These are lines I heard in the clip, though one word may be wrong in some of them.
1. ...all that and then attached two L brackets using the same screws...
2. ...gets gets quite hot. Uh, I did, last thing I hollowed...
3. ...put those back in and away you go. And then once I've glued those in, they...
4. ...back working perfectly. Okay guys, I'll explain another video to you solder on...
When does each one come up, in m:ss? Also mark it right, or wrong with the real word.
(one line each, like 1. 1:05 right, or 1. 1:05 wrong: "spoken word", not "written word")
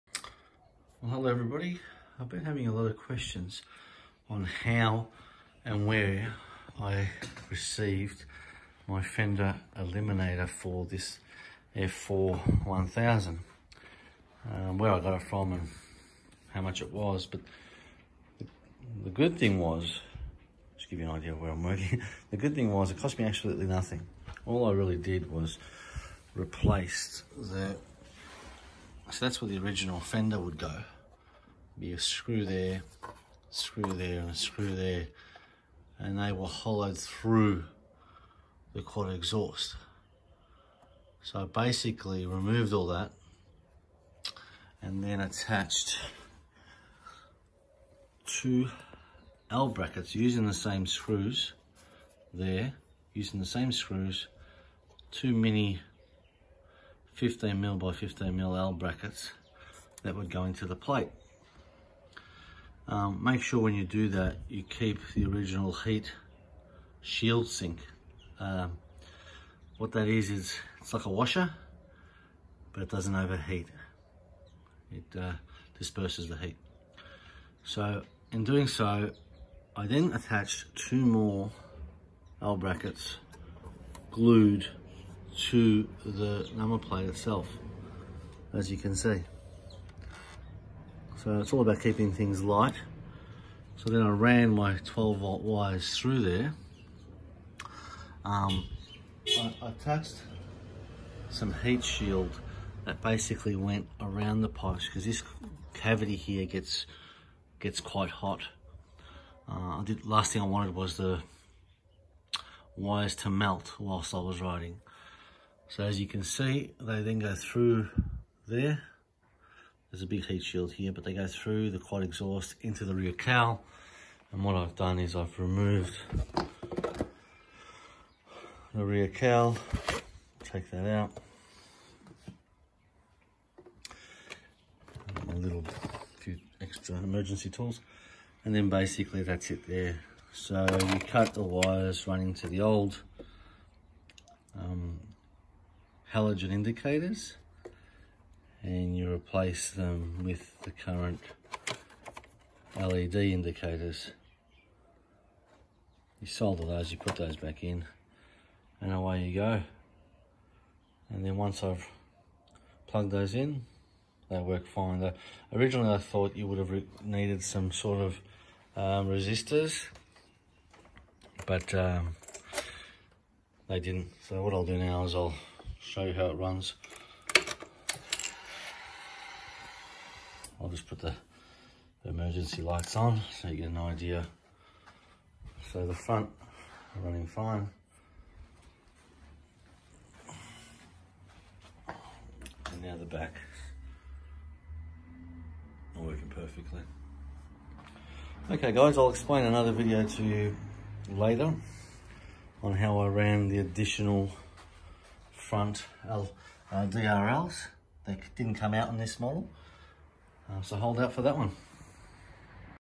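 1. 0:42 right
2. 1:46 wrong: "wanted", not "hollowed"
3. 2:36 wrong: "plugged", not "glued"
4. 3:13 wrong: "later", not "solder".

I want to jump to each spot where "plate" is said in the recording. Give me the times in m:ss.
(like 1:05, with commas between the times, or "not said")
1:00, 1:26.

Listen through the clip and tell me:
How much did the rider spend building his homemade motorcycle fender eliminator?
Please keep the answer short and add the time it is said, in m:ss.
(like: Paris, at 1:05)
Nothing, at 0:23.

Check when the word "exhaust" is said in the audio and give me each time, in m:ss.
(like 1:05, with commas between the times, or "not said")
0:39, 2:02.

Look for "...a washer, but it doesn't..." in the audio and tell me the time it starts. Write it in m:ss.
1:11.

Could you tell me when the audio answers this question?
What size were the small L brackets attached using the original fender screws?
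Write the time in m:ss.
0:57.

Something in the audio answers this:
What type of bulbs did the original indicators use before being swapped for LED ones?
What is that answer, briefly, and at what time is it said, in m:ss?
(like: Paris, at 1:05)
Halogen, at 2:26.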